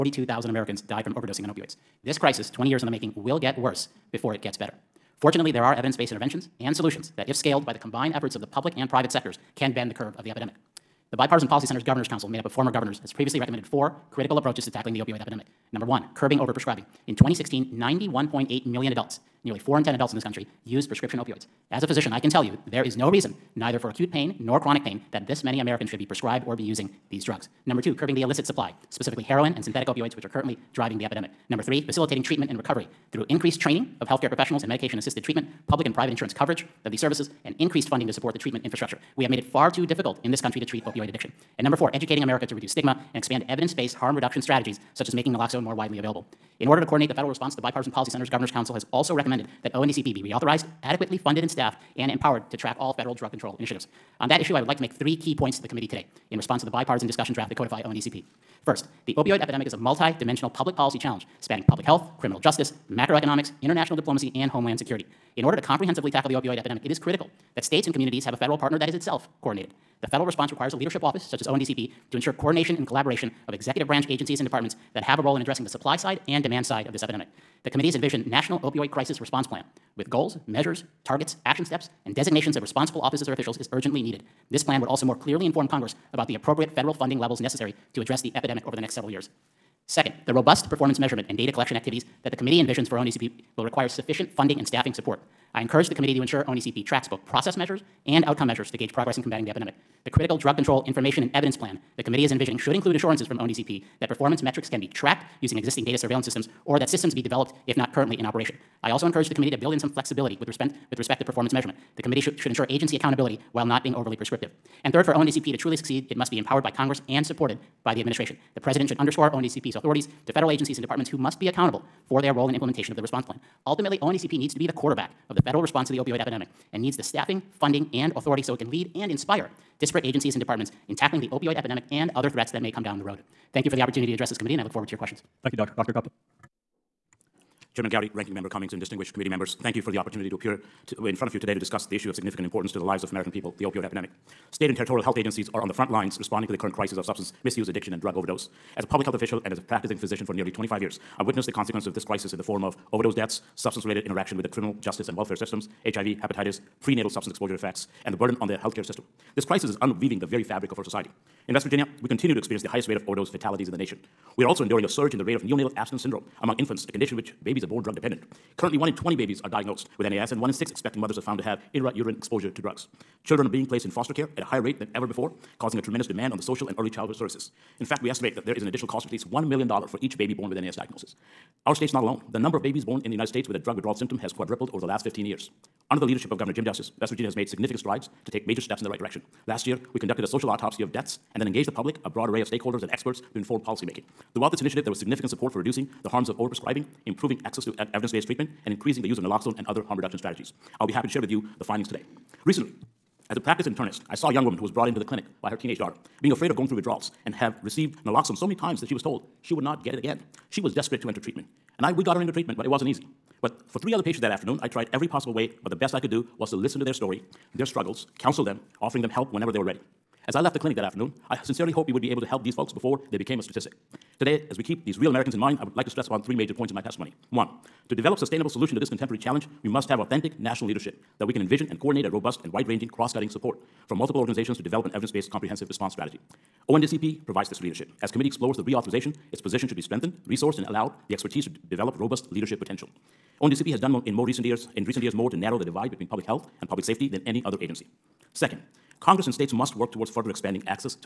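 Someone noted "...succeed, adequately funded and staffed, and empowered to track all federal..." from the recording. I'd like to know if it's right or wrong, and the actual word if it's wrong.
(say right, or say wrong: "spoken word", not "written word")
wrong: "reauthorized", not "succeed".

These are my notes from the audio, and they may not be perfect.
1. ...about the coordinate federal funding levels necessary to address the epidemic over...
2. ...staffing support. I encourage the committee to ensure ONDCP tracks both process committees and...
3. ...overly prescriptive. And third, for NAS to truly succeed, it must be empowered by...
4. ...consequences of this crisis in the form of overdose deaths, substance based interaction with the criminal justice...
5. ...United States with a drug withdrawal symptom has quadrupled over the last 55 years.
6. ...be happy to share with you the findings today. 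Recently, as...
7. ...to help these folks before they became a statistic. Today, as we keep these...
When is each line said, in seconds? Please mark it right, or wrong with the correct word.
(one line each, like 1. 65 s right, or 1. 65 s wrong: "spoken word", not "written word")
1. 86 s wrong: "appropriate", not "coordinate"
2. 94 s wrong: "measures", not "committees"
3. 113 s wrong: "ONDCP", not "NAS"
4. 151 s wrong: "related", not "based"
5. 183 s wrong: "15", not "55"
6. 200 s right
7. 222 s right.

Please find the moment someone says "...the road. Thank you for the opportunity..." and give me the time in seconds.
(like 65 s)
132 s.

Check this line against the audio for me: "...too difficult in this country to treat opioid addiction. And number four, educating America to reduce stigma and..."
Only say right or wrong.
right.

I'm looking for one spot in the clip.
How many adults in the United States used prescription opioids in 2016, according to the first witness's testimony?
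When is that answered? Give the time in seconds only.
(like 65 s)
17 s.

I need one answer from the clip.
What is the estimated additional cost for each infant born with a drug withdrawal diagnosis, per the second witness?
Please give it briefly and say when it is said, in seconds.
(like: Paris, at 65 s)
$1 million, at 179 s.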